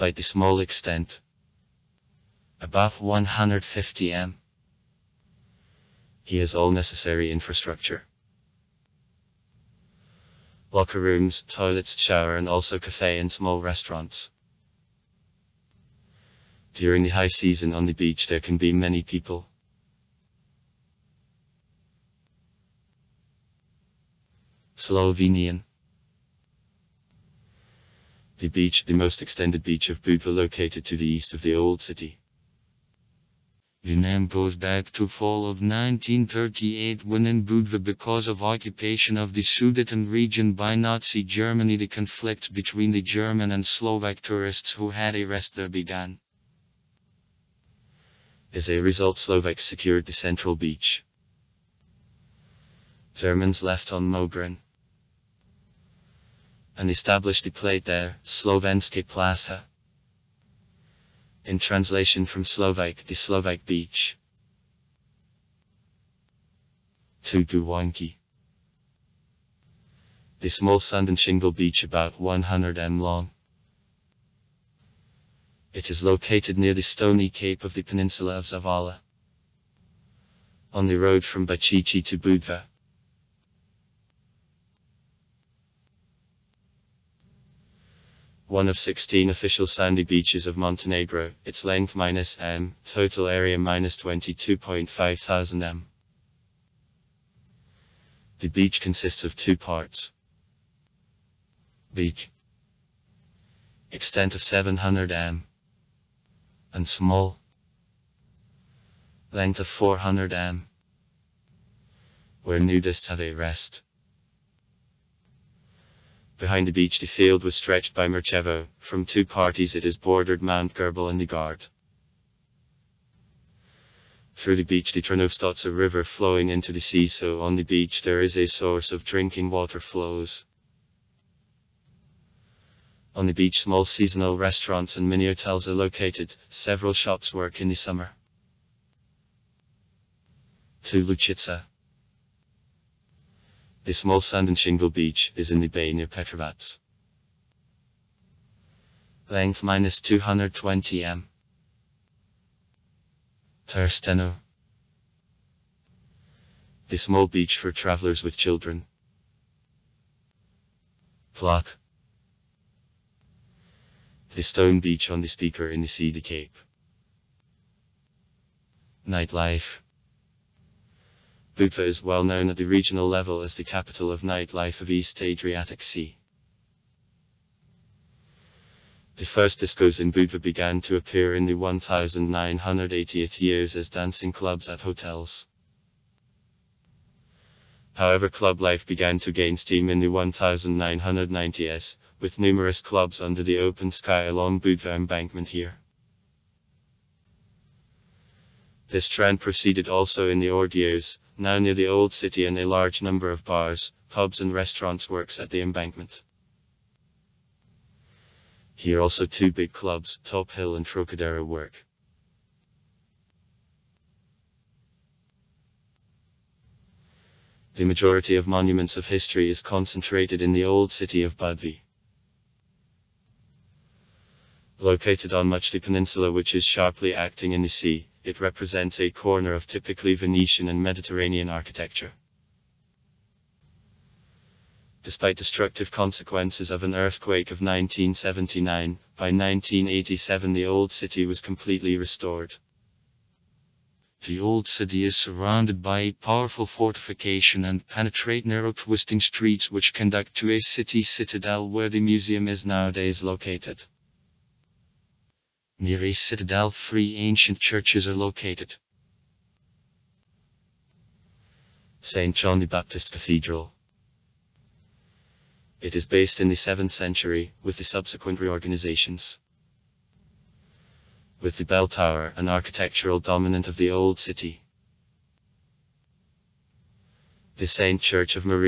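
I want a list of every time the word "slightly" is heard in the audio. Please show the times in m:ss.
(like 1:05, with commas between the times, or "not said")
not said.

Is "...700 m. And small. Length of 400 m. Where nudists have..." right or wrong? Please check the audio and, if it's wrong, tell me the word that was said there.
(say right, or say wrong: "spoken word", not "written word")
right.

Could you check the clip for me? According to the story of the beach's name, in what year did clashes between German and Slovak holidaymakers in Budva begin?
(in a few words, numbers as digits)
1938.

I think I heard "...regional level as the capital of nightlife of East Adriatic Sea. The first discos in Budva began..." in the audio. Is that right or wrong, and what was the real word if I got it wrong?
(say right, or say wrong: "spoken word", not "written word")
right.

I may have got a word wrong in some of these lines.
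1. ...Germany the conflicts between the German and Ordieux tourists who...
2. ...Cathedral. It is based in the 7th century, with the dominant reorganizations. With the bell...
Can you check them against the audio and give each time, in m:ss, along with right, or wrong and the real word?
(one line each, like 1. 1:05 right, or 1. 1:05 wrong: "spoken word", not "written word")
1. 0:41 wrong: "Slovak", not "Ordieux"
2. 4:23 wrong: "subsequent", not "dominant".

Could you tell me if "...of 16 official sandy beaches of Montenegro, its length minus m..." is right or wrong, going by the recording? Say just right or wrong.
right.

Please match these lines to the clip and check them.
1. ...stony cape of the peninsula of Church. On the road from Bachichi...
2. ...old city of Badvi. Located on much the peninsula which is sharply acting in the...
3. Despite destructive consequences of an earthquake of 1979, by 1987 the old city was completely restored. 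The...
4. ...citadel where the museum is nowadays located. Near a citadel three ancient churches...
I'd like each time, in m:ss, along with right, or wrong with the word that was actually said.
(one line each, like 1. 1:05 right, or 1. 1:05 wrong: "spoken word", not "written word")
1. 1:16 wrong: "Zavala", not "Church"
2. 3:40 right
3. 3:55 right
4. 4:11 right.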